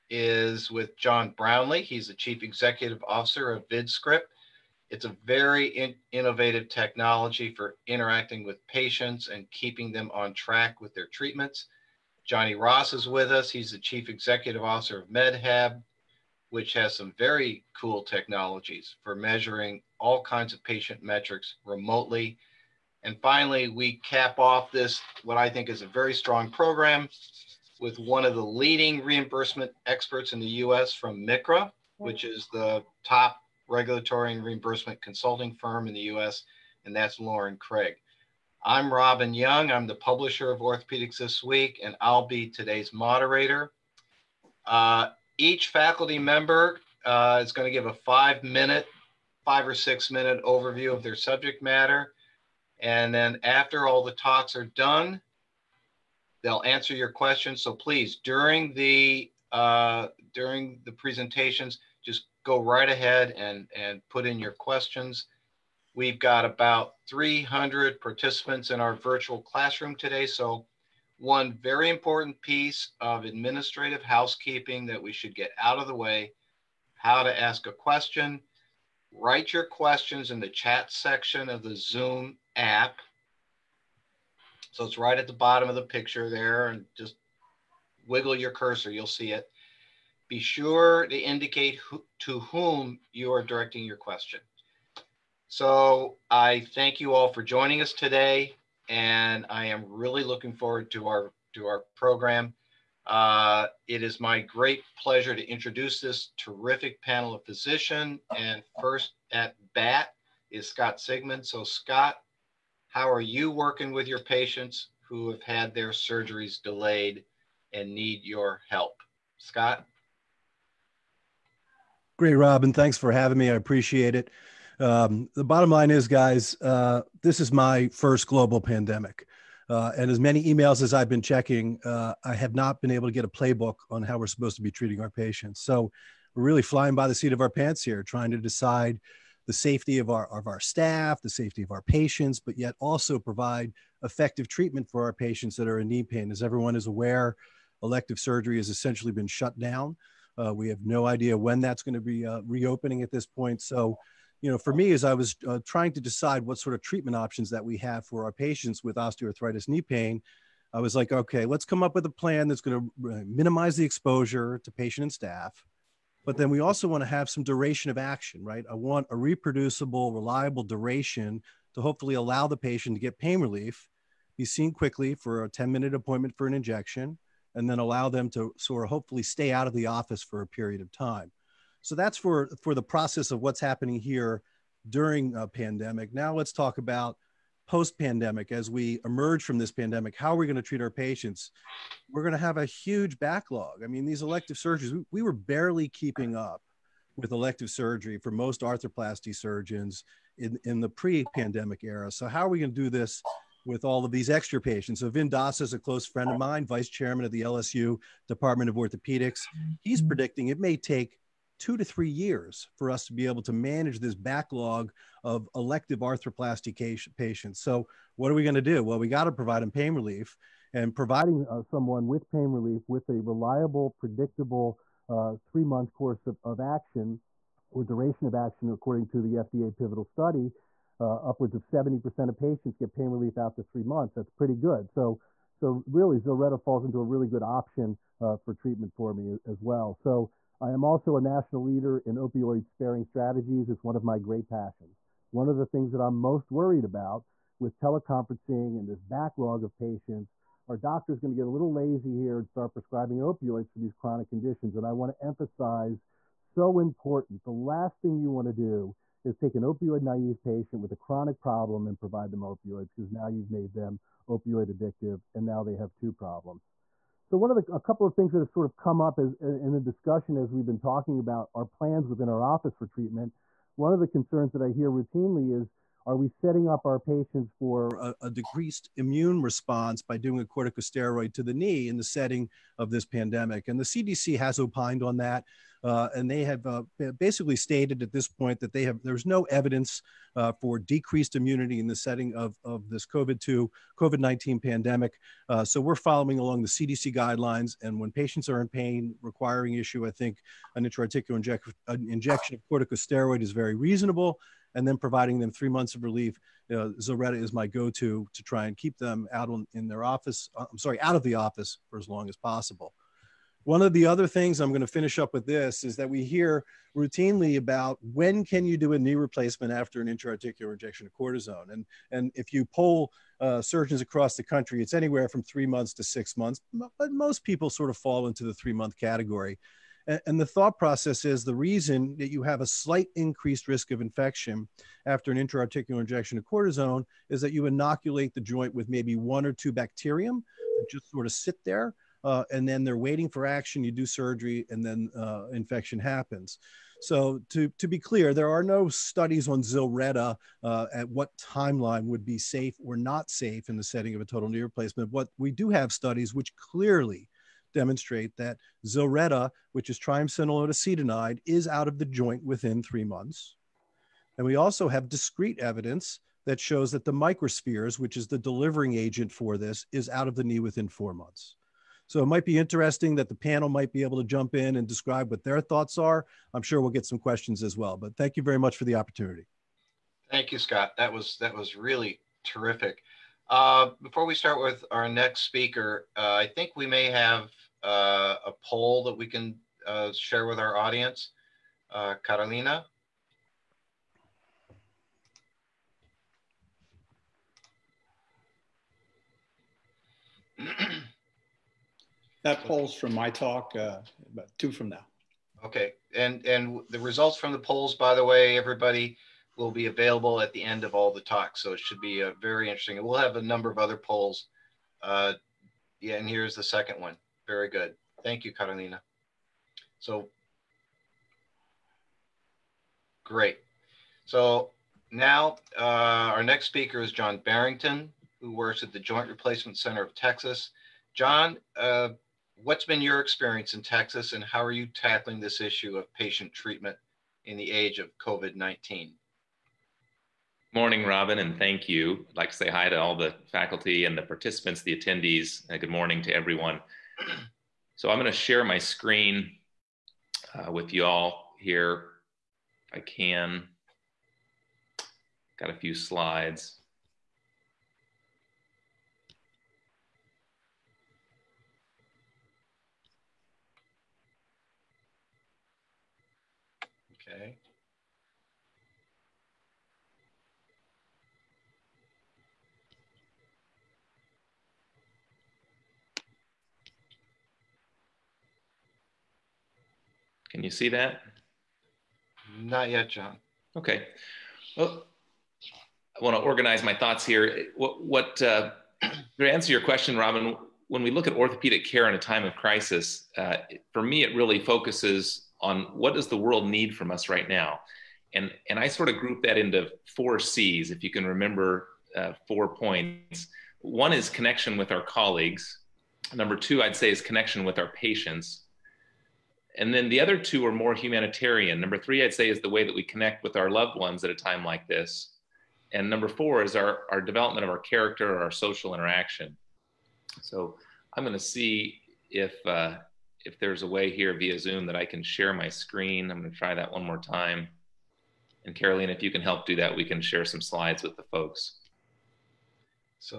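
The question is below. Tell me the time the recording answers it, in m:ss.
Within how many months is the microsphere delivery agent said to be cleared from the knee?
6:10.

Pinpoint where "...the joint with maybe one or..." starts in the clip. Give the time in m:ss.
5:38.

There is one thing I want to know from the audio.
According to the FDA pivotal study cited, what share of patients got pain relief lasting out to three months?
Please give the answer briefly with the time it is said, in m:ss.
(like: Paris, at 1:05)
70%, at 3:51.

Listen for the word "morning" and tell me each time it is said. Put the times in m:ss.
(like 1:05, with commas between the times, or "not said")
7:20, 7:25.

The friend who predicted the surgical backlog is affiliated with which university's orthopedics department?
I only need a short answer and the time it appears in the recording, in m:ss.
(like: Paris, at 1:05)
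LSU, at 3:27.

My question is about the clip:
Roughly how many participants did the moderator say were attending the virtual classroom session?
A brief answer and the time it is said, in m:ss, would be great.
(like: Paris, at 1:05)
300, at 1:07.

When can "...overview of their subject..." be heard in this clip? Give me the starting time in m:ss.
0:50.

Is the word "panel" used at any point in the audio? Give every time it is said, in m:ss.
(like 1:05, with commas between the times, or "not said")
1:47, 6:13.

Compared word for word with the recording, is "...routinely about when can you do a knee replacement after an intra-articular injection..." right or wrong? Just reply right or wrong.
right.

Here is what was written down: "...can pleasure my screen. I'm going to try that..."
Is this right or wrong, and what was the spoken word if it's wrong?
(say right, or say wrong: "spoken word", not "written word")
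wrong: "share", not "pleasure".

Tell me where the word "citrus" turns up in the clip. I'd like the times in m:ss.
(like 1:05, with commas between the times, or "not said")
not said.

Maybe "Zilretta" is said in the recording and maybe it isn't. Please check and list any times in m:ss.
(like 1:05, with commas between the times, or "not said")
3:56, 5:07, 5:49, 5:58.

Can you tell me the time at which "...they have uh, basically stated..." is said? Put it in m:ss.
4:46.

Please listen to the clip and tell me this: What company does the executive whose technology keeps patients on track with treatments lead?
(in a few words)
VidScript.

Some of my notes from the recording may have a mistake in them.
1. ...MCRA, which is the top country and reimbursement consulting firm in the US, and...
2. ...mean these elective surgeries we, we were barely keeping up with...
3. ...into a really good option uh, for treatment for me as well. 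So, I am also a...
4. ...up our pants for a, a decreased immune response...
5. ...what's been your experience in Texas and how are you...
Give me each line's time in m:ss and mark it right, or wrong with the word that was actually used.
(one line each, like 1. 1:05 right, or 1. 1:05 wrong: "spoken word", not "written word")
1. 0:31 wrong: "regulatory", not "country"
2. 3:13 right
3. 3:56 right
4. 4:36 wrong: "patients", not "pants"
5. 7:12 right.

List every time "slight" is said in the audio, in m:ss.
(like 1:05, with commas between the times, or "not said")
5:32.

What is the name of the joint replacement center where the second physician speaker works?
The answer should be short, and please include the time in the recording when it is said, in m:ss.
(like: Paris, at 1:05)
Joint Replacement Center of Texas, at 7:08.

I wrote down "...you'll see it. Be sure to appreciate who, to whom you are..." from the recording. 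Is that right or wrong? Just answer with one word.
wrong.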